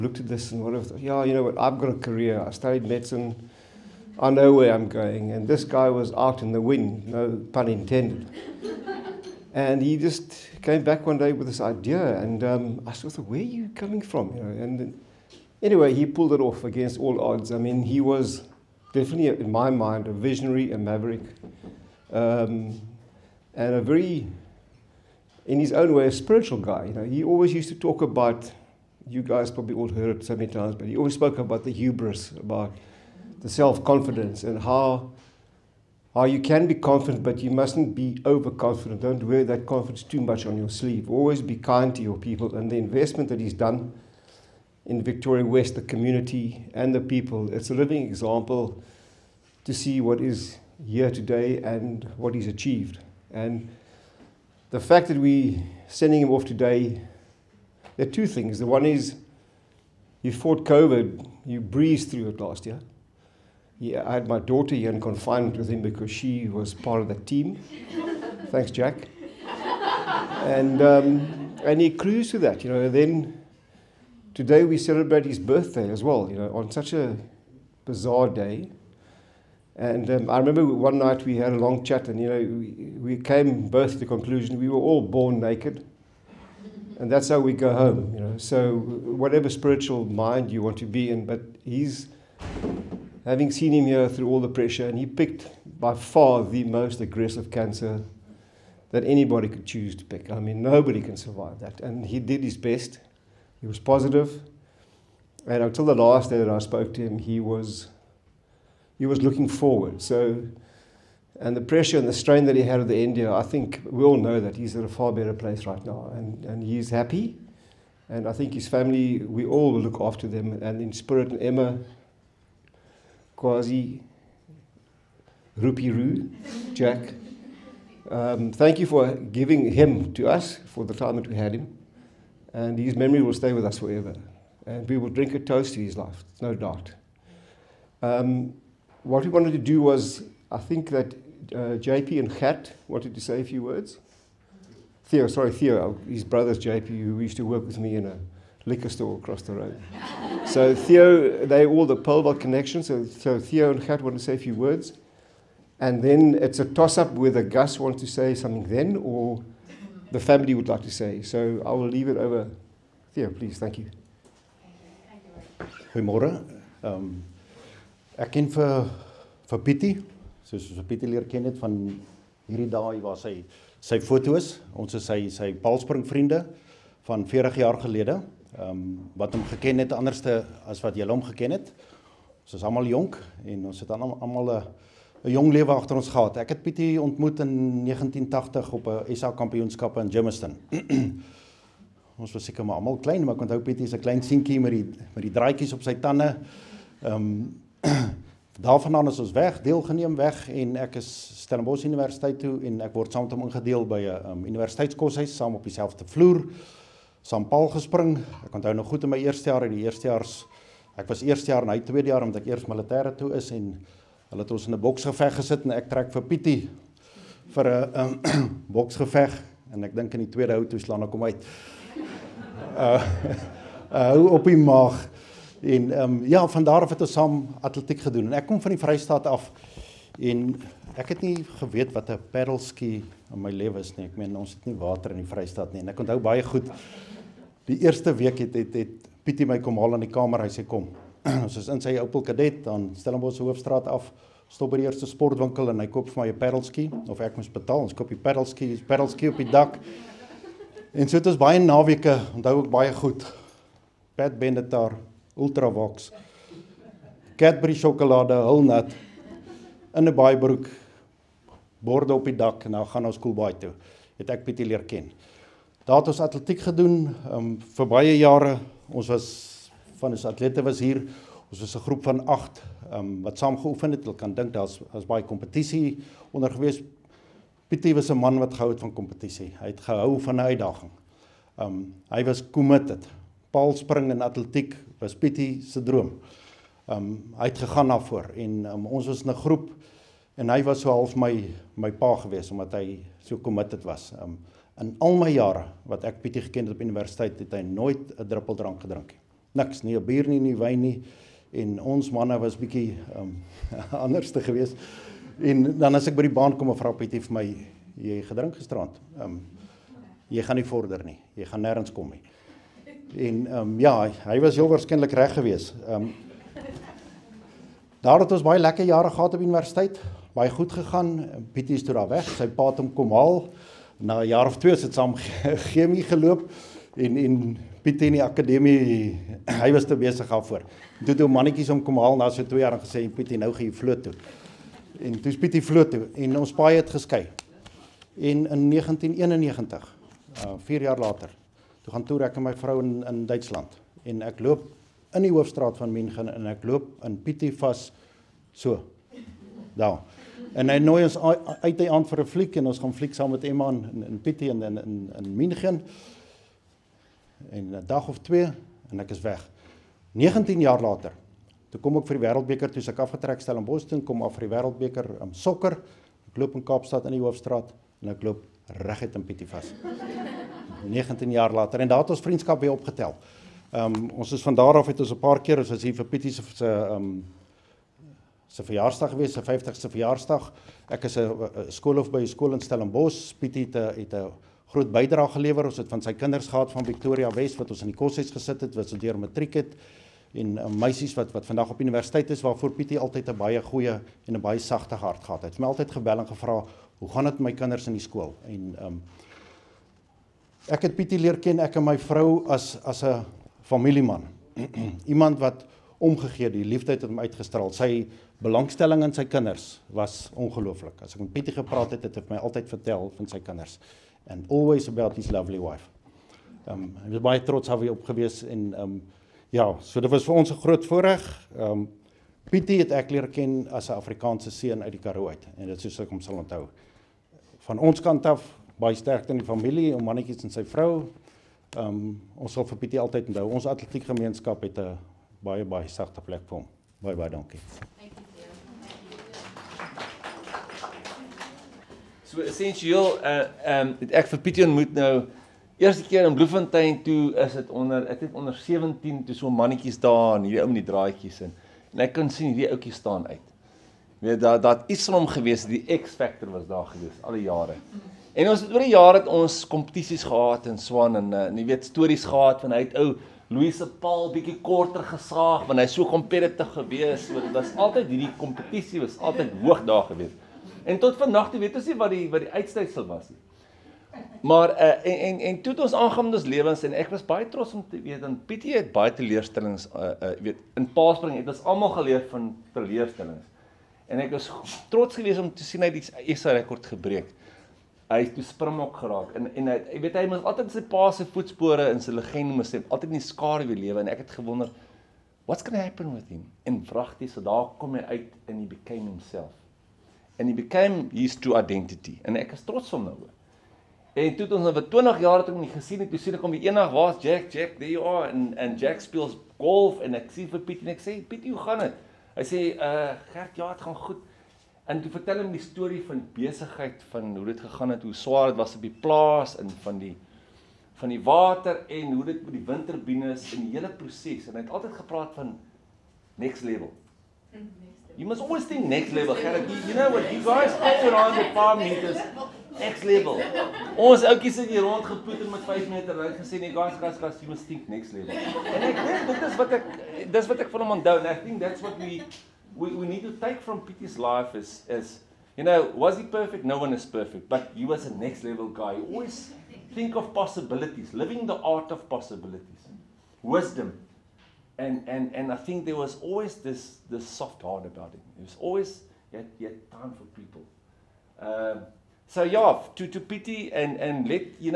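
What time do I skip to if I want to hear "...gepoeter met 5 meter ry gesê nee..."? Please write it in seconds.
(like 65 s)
535 s.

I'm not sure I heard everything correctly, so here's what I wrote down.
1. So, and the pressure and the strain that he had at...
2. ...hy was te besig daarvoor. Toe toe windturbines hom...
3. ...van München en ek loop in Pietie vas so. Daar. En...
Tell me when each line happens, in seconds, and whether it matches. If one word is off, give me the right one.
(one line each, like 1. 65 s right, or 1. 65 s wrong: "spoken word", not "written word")
1. 110 s right
2. 329 s wrong: "mannetjies", not "windturbines"
3. 345 s right.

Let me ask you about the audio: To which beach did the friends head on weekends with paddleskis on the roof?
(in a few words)
Koelbaai.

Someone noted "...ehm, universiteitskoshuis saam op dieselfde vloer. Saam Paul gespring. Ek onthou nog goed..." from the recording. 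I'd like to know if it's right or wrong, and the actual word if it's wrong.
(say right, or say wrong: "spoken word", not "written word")
right.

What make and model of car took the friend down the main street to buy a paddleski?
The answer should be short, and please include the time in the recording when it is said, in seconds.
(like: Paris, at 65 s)
Opel Kadett, at 242 s.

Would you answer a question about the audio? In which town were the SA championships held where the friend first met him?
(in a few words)
Germiston.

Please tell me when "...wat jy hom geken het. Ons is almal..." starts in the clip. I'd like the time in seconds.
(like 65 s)
180 s.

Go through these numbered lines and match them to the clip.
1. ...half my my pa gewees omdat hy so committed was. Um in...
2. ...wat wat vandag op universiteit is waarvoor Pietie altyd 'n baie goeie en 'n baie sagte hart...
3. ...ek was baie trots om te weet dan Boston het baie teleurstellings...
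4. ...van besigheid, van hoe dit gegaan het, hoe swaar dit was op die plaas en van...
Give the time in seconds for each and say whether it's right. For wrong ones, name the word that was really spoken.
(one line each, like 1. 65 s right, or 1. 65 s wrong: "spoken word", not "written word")
1. 290 s right
2. 391 s right
3. 477 s wrong: "Pietie", not "Boston"
4. 516 s right.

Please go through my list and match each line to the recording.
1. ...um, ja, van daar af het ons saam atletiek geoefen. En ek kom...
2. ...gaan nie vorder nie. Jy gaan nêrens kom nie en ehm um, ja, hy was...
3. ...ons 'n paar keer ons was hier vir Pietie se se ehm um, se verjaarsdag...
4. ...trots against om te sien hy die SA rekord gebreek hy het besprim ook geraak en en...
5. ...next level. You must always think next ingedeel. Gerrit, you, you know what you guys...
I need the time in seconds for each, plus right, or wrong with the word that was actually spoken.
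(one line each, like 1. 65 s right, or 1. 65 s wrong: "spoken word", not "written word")
1. 226 s wrong: "gedoen", not "geoefen"
2. 310 s right
3. 375 s right
4. 484 s wrong: "geweest", not "against"
5. 526 s wrong: "level", not "ingedeel".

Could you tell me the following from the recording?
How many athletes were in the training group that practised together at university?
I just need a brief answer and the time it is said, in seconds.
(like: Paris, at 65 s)
8, at 272 s.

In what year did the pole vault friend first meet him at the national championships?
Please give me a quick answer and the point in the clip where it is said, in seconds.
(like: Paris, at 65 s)
1980, at 187 s.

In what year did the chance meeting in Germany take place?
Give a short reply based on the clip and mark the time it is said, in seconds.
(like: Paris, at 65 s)
1991, at 338 s.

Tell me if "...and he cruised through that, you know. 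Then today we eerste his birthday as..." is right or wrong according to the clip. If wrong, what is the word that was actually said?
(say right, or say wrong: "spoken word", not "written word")
wrong: "celebrate", not "eerste".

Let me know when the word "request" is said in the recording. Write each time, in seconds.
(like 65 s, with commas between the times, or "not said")
not said.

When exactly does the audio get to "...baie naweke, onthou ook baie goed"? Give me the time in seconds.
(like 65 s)
251 s.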